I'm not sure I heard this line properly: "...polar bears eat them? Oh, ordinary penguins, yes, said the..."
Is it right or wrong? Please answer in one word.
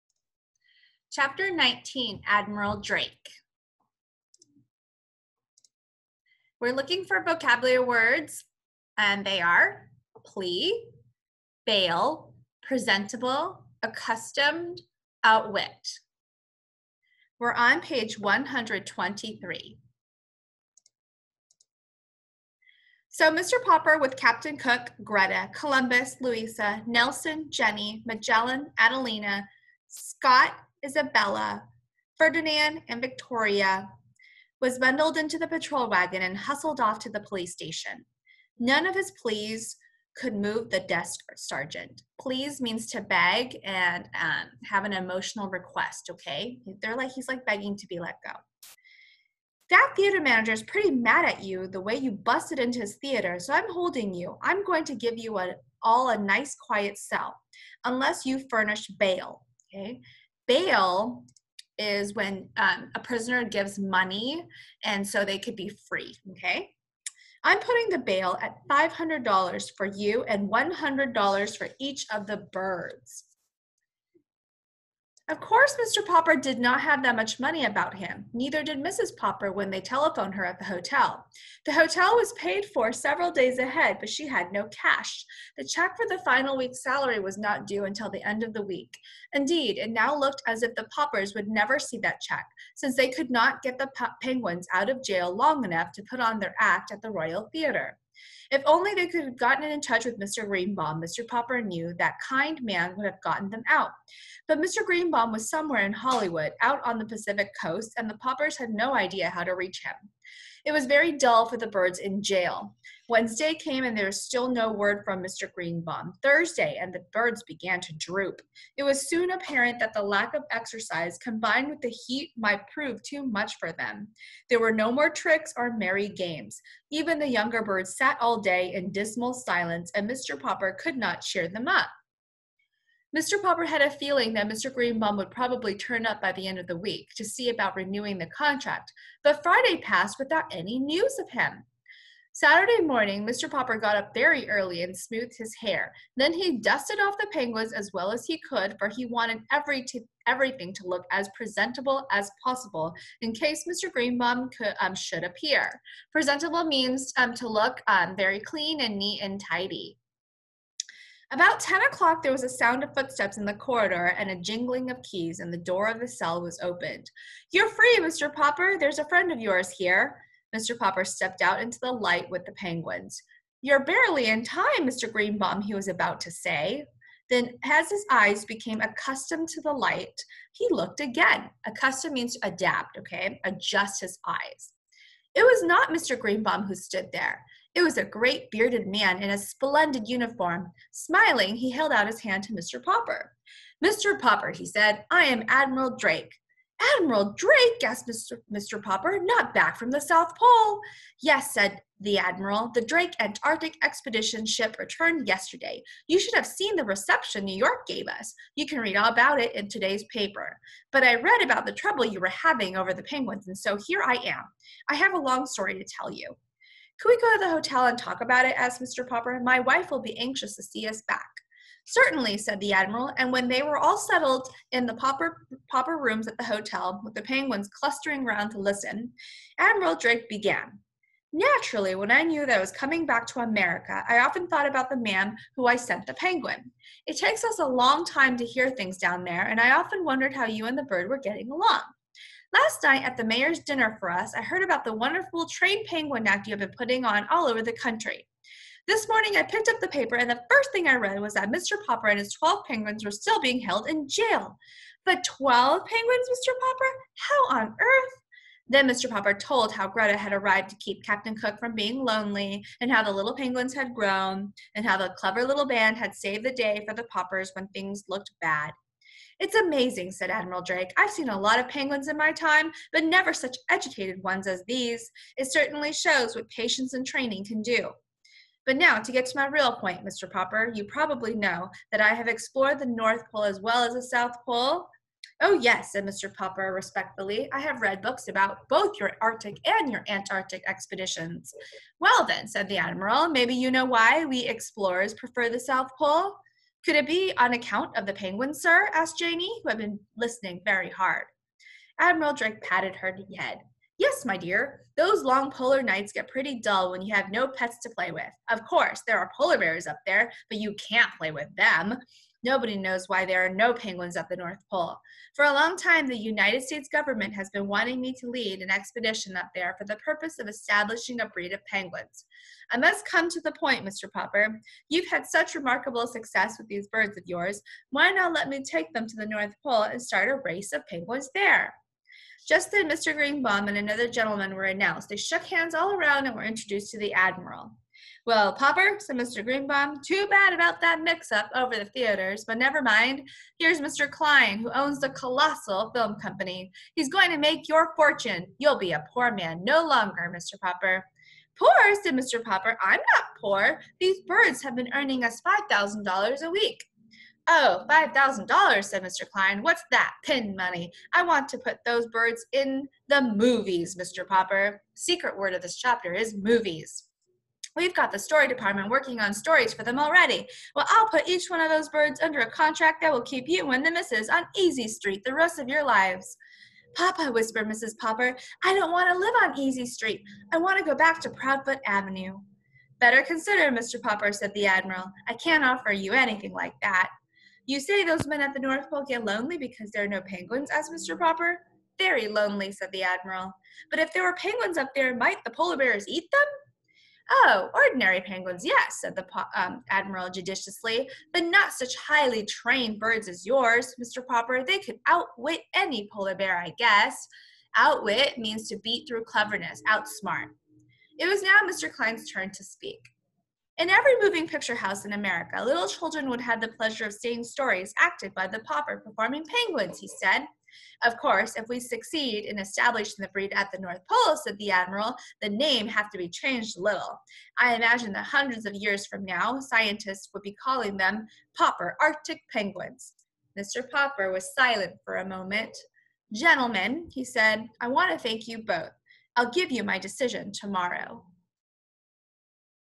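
right.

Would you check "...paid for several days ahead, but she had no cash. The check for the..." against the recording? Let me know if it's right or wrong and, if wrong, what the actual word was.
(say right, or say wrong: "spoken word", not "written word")
right.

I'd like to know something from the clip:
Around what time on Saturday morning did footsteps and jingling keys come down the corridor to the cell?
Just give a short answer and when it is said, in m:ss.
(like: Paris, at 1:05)
10 o'clock, at 2:41.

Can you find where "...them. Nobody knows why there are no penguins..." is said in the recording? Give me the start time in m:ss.
5:11.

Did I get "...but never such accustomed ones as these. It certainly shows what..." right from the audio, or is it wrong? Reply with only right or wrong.
wrong.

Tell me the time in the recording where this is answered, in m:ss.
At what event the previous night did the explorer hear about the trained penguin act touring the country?
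4:03.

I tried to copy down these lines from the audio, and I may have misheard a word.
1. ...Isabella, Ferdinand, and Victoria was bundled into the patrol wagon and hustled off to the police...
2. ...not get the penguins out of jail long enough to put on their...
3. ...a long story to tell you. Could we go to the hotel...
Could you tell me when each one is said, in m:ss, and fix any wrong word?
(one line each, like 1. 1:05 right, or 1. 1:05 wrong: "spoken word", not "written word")
1. 0:30 right
2. 1:33 right
3. 3:35 right.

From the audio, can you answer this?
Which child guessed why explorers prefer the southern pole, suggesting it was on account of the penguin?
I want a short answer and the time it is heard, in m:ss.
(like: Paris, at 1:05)
Janie, at 4:59.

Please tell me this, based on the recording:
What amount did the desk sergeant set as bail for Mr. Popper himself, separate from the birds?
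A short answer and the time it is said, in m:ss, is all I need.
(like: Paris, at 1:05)
$500, at 1:08.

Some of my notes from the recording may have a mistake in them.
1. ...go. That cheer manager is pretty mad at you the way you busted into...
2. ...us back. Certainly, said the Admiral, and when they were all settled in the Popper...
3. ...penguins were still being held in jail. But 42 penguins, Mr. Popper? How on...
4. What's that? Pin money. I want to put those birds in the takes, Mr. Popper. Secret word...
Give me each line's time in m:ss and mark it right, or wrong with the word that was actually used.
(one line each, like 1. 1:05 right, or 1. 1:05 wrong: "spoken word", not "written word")
1. 0:48 wrong: "theater", not "cheer"
2. 3:40 right
3. 4:12 wrong: "12", not "42"
4. 5:59 wrong: "movies", not "takes".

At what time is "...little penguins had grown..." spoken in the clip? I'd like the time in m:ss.
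4:23.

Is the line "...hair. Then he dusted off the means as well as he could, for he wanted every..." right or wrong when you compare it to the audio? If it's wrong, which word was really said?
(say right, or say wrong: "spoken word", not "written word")
wrong: "penguins", not "means".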